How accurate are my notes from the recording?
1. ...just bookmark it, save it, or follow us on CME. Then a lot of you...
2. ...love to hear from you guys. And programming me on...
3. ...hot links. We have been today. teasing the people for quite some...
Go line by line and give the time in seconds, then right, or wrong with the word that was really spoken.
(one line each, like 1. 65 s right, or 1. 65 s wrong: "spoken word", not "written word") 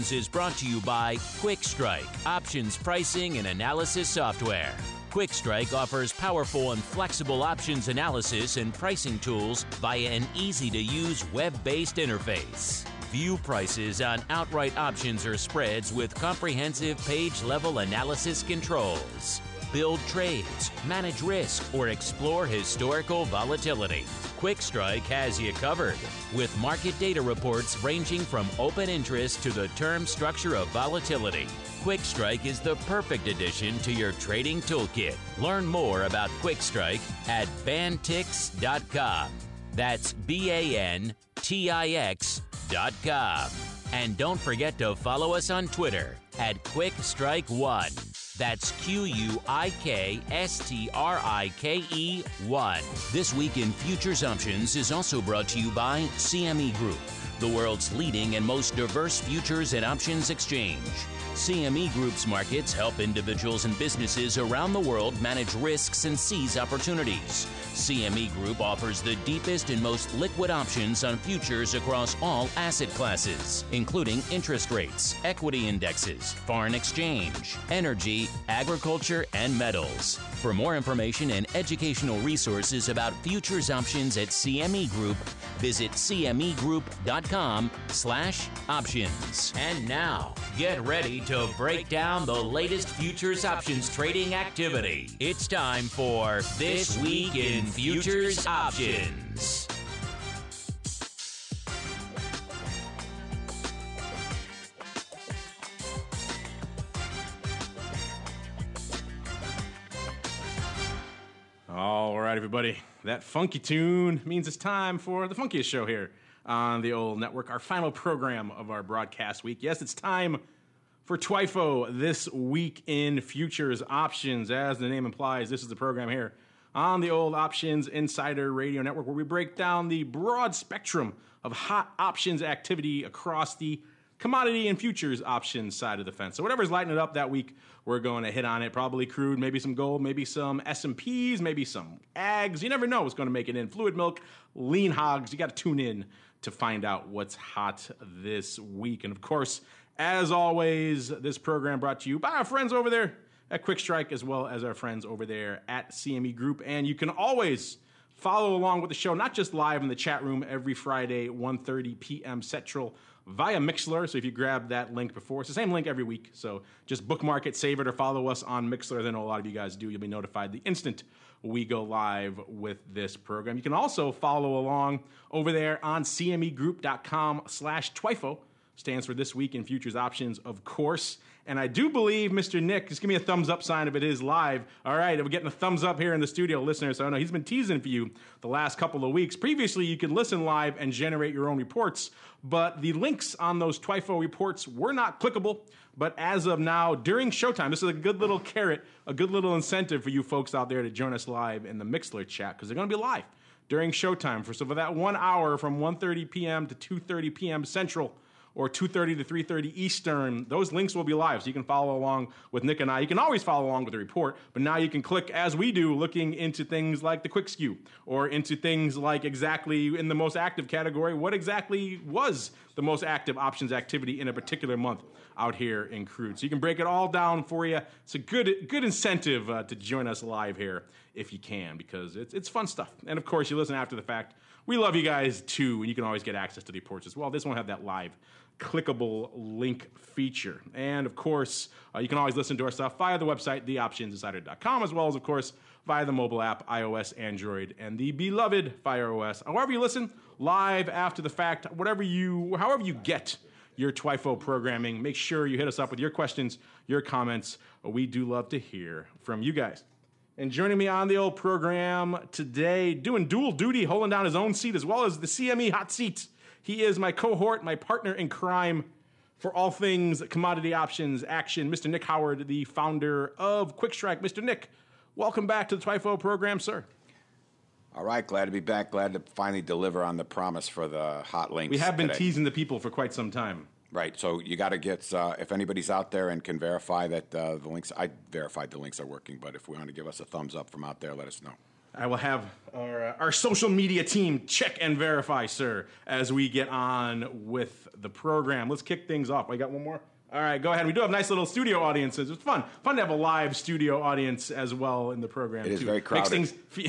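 1. 166 s wrong: "Mixlr", not "CME"
2. 258 s wrong: "joining", not "programming"
3. 281 s right.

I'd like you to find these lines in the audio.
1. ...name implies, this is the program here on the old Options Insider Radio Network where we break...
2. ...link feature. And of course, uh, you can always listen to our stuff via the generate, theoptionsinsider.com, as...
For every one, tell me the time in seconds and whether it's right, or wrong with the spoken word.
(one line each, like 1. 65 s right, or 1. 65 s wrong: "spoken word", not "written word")
1. 124 s right
2. 239 s wrong: "website", not "generate".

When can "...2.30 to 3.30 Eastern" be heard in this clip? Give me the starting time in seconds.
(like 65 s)
208 s.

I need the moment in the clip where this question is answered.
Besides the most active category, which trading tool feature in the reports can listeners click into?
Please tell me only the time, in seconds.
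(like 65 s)
217 s.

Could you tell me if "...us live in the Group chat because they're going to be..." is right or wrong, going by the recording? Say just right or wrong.
wrong.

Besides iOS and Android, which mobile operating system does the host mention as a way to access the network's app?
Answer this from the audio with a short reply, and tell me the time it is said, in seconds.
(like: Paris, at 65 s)
Fire OS, at 248 s.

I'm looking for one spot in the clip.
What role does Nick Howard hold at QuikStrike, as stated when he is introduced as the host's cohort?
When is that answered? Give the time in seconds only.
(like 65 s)
272 s.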